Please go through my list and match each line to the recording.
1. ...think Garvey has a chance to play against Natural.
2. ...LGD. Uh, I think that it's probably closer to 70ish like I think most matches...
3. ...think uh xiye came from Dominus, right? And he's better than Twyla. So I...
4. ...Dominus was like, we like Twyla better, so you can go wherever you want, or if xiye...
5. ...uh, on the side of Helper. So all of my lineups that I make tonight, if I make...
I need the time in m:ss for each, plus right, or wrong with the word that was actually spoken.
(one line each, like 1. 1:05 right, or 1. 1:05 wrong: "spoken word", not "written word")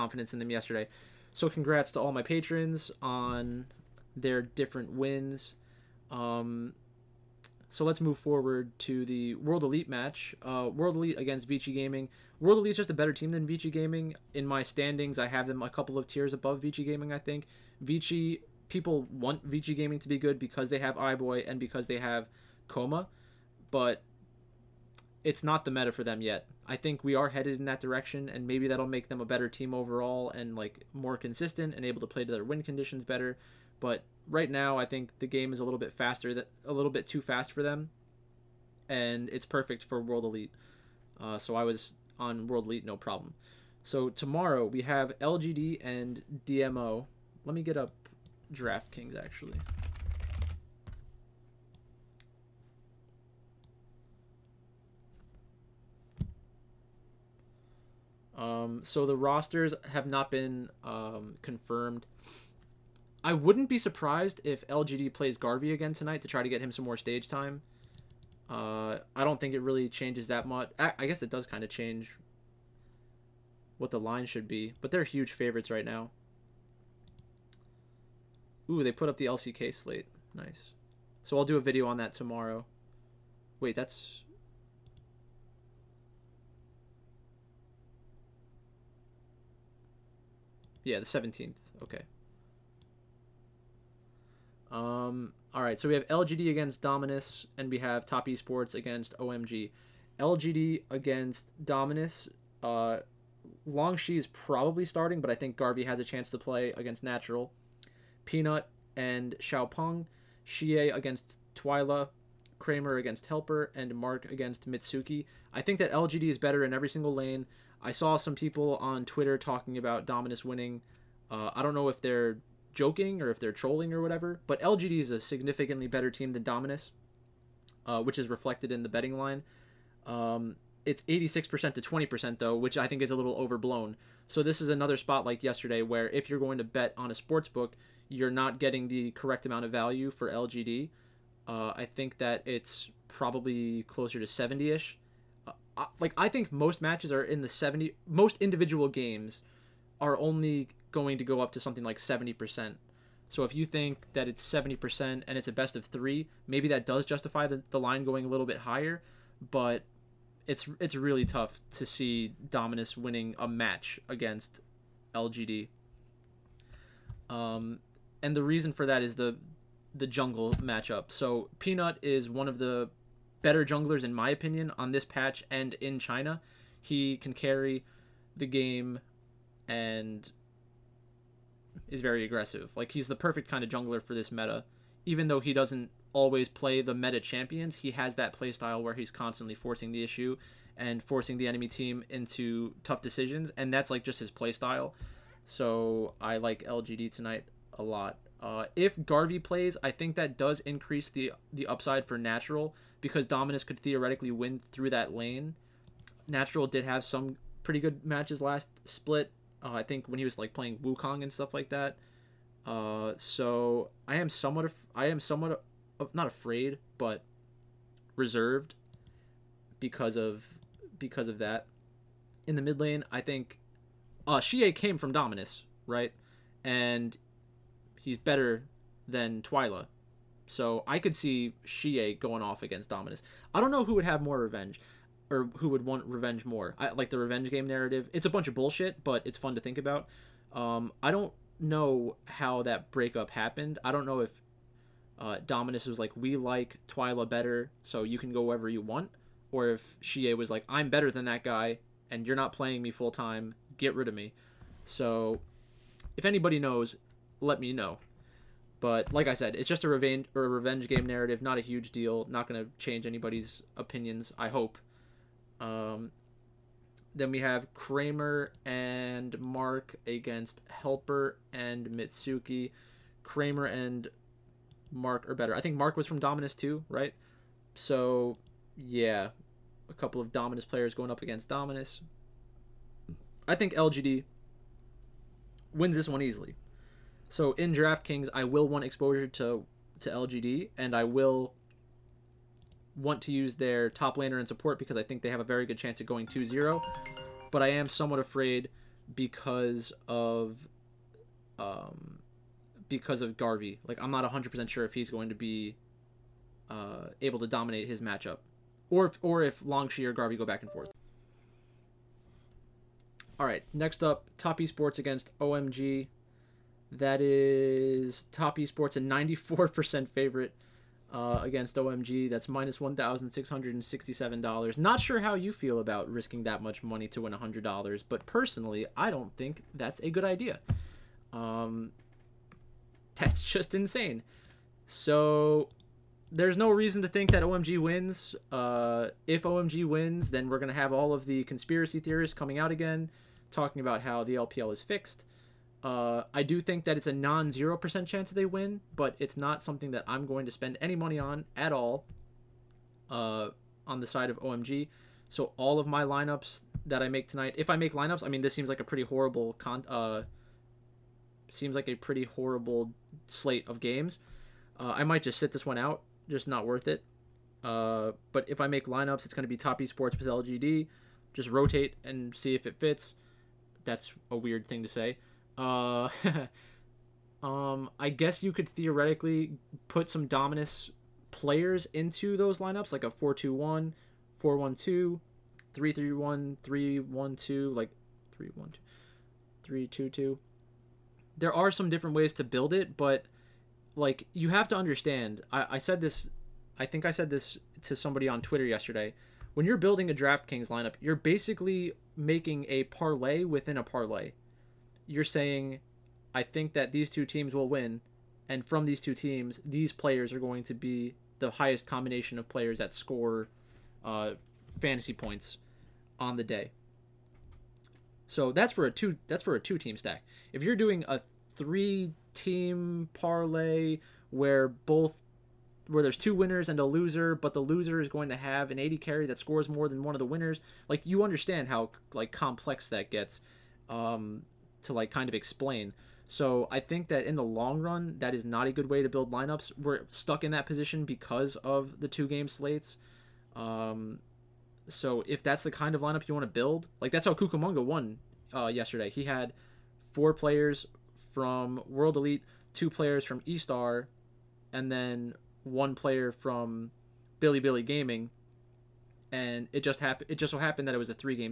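1. 1:45 right
2. 2:20 right
3. 3:43 right
4. 4:05 right
5. 5:53 wrong: "OMG", not "Helper".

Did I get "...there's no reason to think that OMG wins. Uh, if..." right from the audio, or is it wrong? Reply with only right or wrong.
right.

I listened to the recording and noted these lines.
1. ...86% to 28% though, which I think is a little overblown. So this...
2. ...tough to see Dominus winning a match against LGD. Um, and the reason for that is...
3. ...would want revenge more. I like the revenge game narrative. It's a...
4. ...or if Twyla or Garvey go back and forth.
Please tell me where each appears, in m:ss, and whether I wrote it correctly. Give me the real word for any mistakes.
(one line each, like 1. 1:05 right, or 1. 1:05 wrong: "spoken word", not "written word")
1. 2:11 wrong: "20", not "28"
2. 2:41 right
3. 3:55 right
4. 5:09 wrong: "Longshi", not "Twyla".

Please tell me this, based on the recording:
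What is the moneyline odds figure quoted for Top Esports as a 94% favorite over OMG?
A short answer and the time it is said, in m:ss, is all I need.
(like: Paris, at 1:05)
-$1,667, at 5:22.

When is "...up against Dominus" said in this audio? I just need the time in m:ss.
4:41.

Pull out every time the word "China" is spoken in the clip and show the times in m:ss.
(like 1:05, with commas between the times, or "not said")
2:55.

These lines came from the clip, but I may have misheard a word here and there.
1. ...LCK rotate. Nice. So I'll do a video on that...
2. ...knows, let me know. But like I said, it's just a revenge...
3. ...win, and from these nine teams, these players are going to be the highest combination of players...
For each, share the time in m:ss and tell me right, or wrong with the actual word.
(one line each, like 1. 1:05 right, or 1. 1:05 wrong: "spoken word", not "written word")
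1. 1:19 wrong: "slate", not "rotate"
2. 4:16 right
3. 6:47 wrong: "two", not "nine".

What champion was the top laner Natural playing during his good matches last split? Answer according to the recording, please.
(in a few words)
Wukong.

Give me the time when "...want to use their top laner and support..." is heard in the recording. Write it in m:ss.
4:52.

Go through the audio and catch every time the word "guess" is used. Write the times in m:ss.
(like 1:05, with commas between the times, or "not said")
1:11, 6:18.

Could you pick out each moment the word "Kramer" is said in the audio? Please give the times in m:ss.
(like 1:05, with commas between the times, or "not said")
1:52, 4:27, 4:33.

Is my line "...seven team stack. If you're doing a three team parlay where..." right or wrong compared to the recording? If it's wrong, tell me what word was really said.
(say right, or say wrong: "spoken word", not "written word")
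wrong: "two", not "seven".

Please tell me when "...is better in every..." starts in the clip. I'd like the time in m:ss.
1:56.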